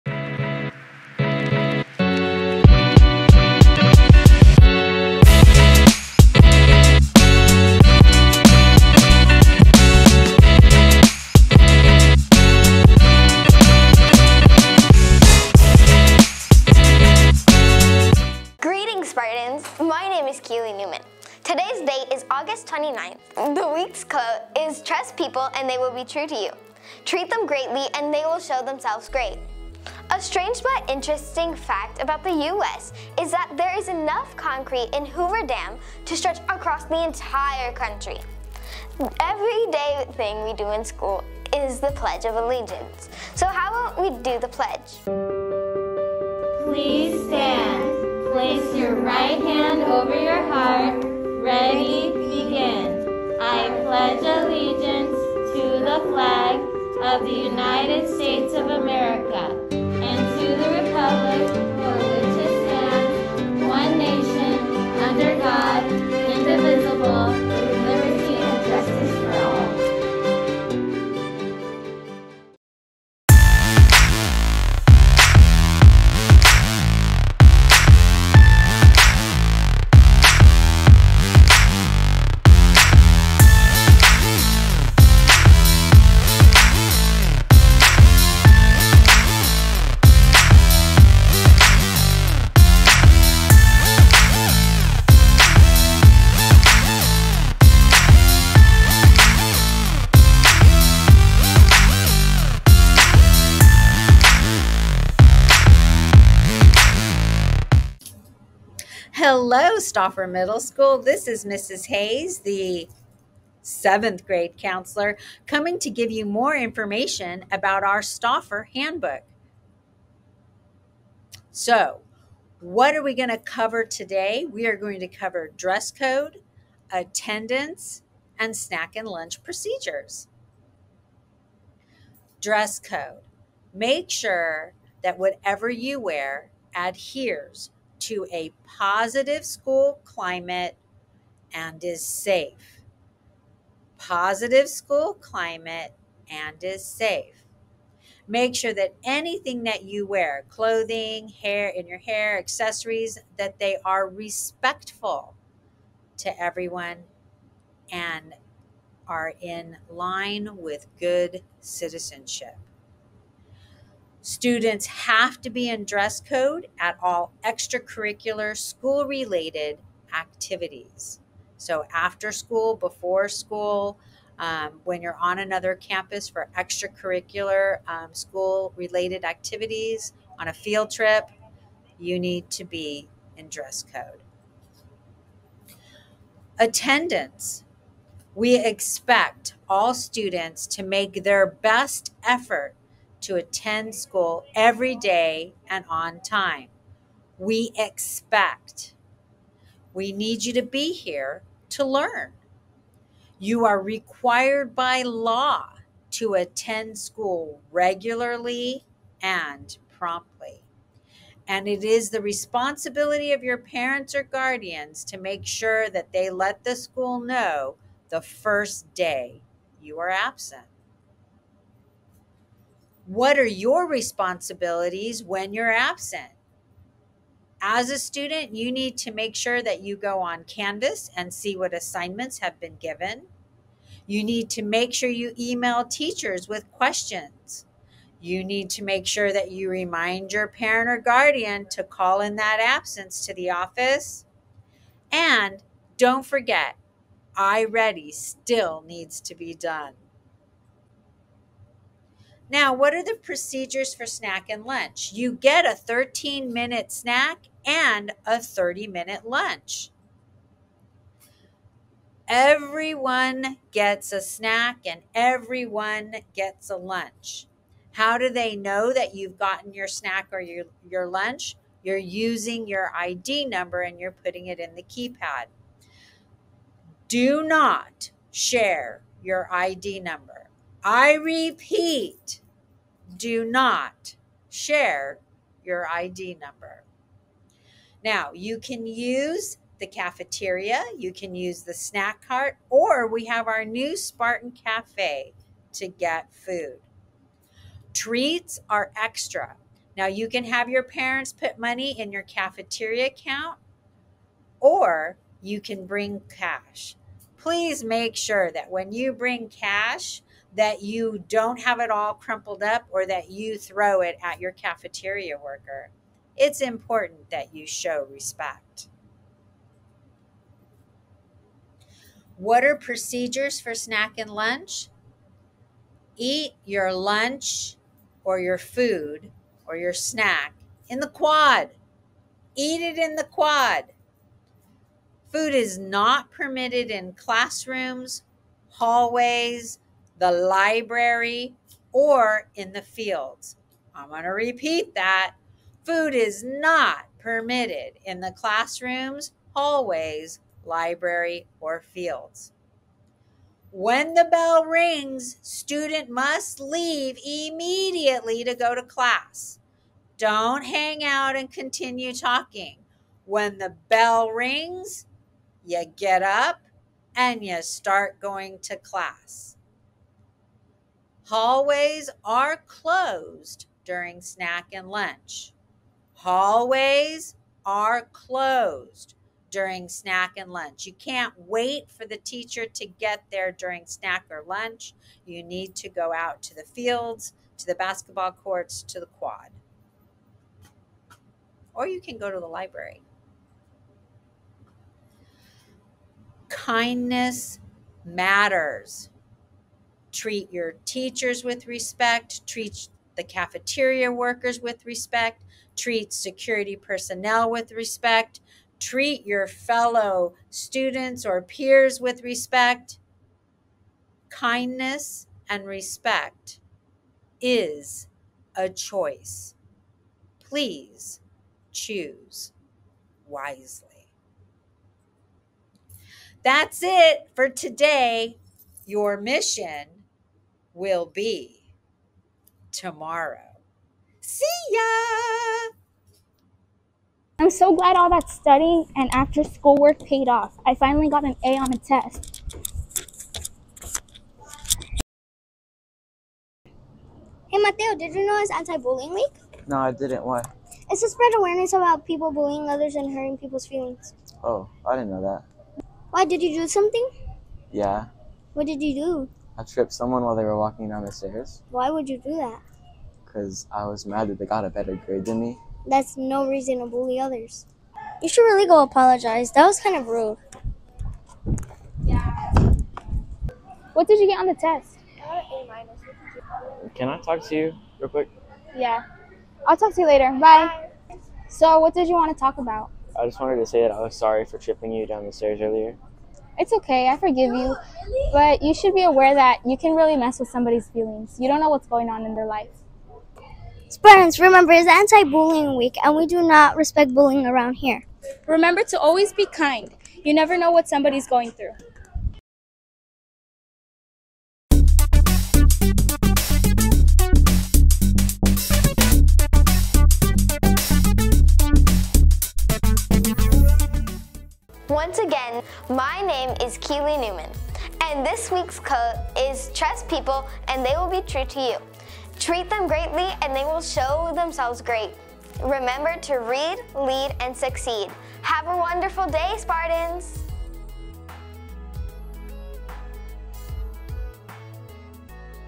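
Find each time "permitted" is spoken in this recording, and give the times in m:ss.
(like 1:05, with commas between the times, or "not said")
5:36, 5:47.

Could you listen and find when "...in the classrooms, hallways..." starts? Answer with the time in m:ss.
5:48.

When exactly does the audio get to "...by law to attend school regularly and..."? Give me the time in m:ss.
3:24.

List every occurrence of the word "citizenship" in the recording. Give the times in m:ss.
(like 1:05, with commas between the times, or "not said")
2:41.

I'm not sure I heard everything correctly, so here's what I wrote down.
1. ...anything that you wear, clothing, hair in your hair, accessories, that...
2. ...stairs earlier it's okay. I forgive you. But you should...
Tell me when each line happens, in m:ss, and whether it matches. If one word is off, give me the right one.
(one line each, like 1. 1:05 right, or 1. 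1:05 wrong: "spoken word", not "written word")
1. 2:29 right
2. 8:05 right.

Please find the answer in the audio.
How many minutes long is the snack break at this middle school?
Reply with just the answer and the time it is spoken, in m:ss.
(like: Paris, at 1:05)
13, at 4:15.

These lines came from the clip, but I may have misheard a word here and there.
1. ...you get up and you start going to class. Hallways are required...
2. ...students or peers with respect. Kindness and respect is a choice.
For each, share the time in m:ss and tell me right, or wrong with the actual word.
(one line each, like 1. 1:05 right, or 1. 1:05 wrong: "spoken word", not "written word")
1. 6:05 wrong: "closed", not "required"
2. 6:50 right.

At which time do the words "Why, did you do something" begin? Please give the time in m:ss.
7:36.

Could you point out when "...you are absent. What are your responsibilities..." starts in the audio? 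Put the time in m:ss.
3:39.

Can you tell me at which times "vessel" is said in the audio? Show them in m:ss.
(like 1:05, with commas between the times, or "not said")
not said.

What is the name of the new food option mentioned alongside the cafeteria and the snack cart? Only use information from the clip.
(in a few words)
Spartan Cafe.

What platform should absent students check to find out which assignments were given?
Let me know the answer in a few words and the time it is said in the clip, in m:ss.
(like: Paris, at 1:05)
Canvas, at 3:50.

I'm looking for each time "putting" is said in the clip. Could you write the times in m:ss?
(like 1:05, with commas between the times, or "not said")
4:34.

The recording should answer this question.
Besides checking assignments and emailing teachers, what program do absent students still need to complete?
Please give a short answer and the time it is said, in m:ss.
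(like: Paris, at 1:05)
iReady, at 4:07.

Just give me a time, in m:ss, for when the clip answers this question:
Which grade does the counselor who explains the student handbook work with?
1:53.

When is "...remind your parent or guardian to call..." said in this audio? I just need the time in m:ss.
3:59.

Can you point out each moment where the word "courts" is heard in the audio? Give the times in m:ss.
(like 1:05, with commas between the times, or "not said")
6:28.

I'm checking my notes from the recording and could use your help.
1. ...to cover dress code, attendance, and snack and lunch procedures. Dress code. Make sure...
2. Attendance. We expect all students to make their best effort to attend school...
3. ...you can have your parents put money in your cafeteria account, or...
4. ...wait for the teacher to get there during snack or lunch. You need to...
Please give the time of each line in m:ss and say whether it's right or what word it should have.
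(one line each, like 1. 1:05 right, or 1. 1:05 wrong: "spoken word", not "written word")
1. 2:05 right
2. 3:06 right
3. 5:00 right
4. 6:21 right.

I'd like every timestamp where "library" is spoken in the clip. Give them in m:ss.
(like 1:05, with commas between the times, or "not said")
5:40, 5:50, 6:32.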